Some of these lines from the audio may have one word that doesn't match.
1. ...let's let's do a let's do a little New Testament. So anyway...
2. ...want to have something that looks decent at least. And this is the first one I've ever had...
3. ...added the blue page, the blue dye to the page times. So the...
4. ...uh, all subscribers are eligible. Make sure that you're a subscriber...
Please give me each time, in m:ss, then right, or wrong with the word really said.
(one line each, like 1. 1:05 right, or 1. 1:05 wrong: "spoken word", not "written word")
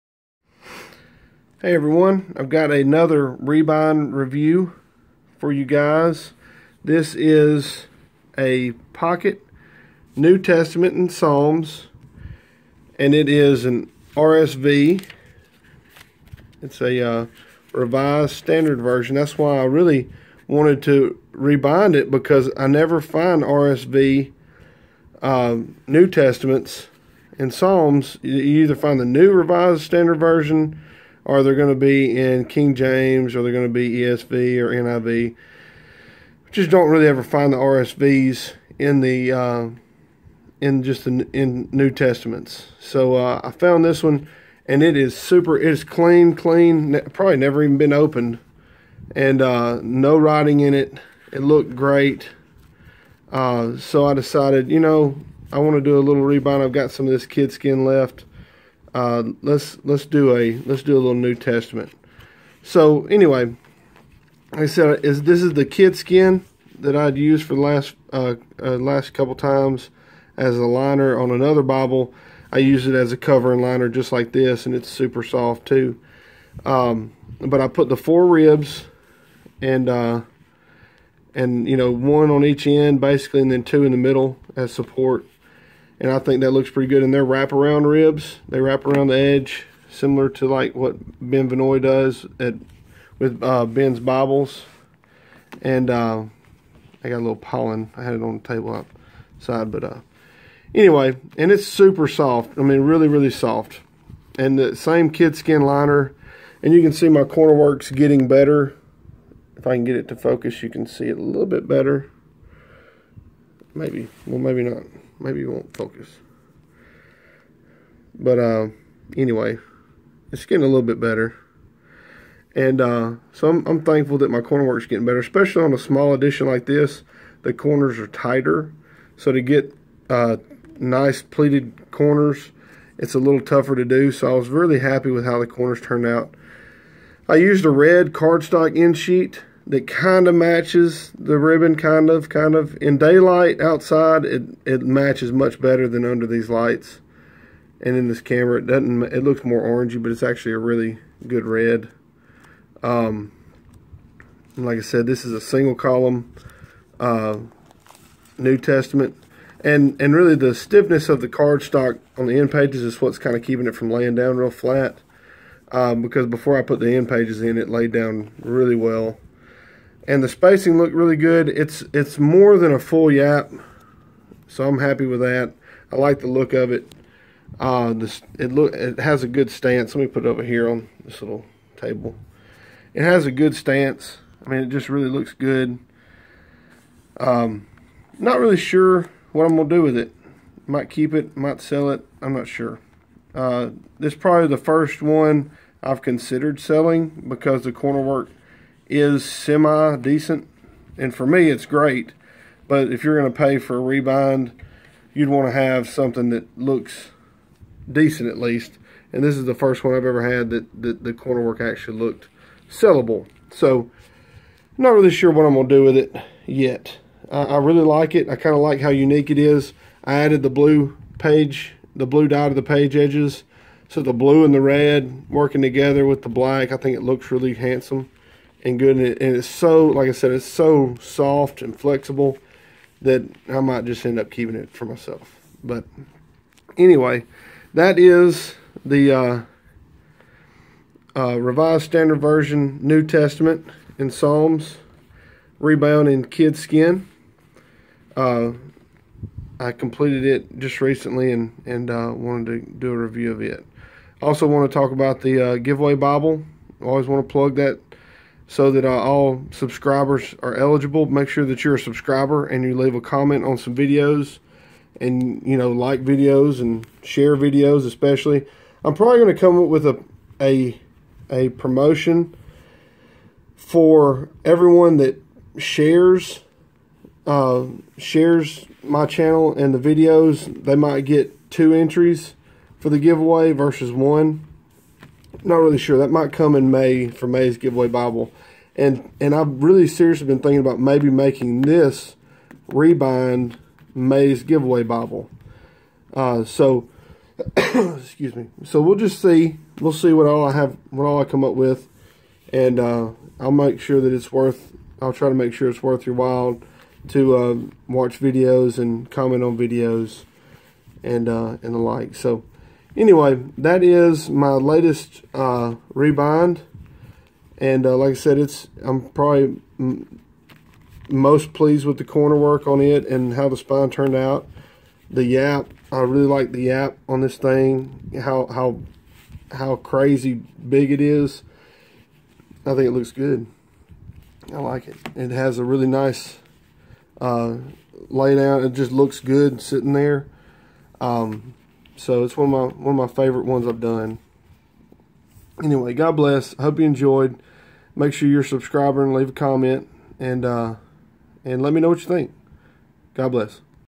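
1. 0:59 right
2. 3:25 right
3. 3:40 wrong: "edges", not "times"
4. 4:18 right.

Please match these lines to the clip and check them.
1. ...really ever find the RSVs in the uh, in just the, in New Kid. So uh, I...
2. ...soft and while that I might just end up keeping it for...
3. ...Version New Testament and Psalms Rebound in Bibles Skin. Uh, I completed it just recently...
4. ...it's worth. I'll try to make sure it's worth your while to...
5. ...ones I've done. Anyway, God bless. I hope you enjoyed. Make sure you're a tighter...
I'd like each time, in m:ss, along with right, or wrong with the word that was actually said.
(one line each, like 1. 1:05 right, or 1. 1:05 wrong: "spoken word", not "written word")
1. 0:36 wrong: "Testaments", not "Kid"
2. 3:50 wrong: "flexible", not "while"
3. 4:02 wrong: "Kid", not "Bibles"
4. 5:04 right
5. 5:43 wrong: "subscriber", not "tighter".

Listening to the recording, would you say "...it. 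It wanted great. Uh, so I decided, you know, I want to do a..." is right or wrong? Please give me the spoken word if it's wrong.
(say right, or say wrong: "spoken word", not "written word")
wrong: "looked", not "wanted".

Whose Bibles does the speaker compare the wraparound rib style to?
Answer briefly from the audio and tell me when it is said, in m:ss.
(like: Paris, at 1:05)
Ben Vinoy, at 1:31.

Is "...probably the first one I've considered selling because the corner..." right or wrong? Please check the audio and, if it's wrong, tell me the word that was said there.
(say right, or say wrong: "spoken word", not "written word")
right.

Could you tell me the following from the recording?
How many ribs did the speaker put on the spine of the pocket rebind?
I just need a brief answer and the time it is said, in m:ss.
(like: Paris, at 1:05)
4, at 1:17.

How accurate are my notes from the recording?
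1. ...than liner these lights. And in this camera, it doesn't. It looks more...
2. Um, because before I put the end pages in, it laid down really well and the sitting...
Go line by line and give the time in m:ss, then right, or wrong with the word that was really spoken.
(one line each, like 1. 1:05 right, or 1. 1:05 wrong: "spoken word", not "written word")
1. 2:25 wrong: "under", not "liner"
2. 2:45 wrong: "spacing", not "sitting".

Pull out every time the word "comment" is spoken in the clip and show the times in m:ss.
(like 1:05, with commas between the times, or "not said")
4:22, 5:09, 5:49.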